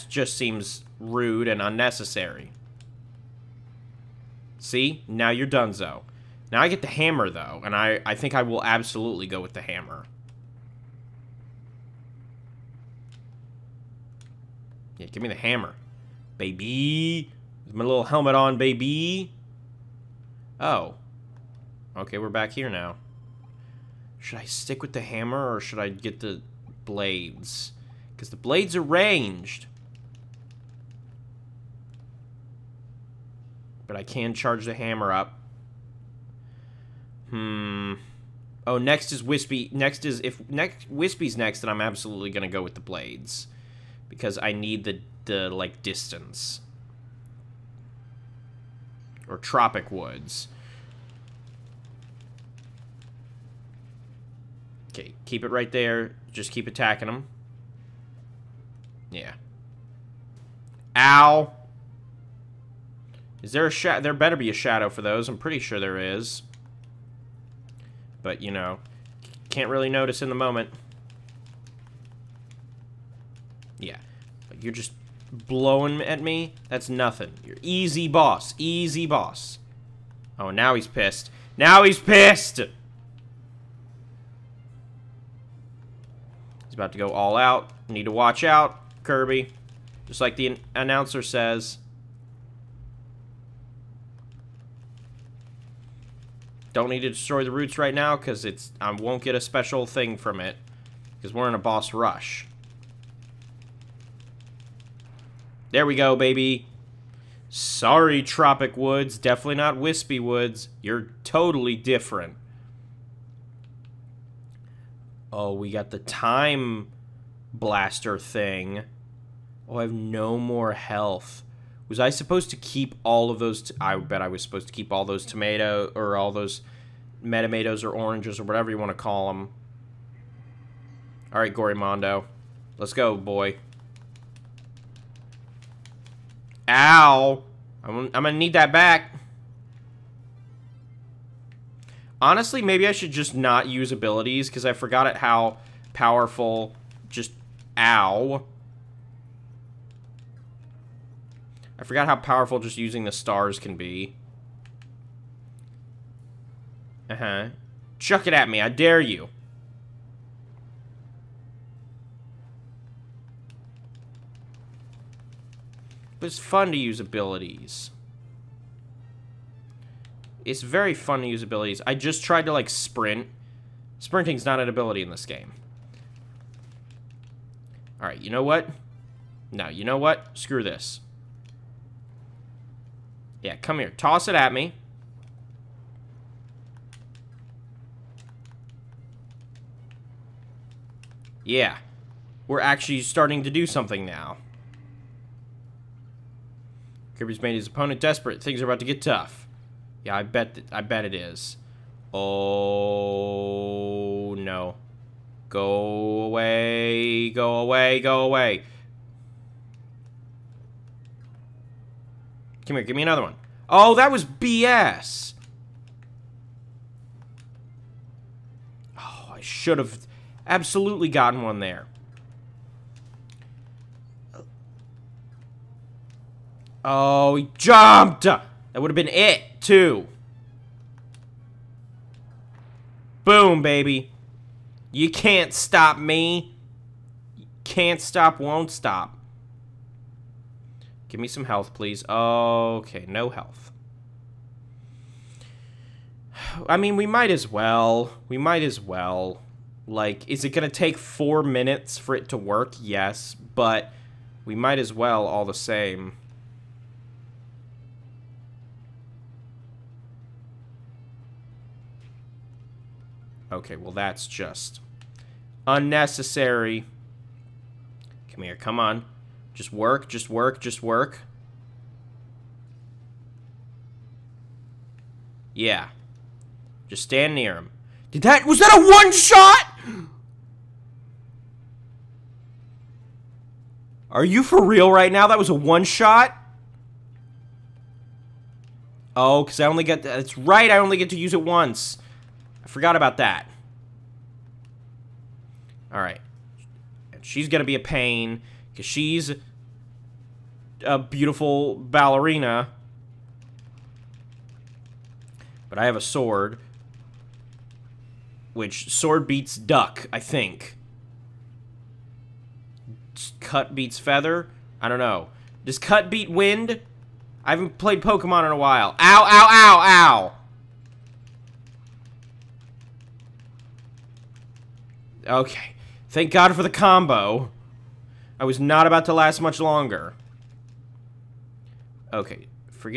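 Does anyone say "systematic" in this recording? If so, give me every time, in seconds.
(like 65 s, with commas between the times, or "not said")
not said.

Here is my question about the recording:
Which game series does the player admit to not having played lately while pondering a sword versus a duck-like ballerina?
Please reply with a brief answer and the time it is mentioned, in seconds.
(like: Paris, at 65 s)
Pokemon, at 318 s.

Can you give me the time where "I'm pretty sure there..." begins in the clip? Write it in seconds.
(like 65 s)
65 s.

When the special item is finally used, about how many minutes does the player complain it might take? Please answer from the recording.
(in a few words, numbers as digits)
4.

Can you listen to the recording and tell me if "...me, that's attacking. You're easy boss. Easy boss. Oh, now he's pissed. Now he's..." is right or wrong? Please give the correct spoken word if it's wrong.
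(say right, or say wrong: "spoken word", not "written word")
wrong: "nothing", not "attacking".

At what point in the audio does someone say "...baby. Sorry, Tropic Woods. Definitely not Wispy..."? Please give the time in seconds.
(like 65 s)
106 s.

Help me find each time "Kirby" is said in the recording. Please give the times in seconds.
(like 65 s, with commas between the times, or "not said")
89 s, 197 s.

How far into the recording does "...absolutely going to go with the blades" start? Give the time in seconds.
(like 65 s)
41 s.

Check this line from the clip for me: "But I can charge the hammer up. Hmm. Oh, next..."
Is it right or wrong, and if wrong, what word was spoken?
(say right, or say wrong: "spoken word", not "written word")
right.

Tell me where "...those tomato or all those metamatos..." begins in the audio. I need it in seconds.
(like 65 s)
125 s.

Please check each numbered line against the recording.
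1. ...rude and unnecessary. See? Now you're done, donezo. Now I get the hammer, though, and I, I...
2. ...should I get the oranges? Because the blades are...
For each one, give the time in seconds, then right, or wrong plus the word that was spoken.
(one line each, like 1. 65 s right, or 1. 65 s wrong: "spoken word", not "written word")
1. 0 s right
2. 25 s wrong: "blades", not "oranges".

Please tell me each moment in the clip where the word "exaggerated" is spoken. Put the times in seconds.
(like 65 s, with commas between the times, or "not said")
not said.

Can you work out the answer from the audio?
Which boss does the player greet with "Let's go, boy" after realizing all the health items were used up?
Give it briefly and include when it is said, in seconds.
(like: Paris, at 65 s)
Mondo, at 131 s.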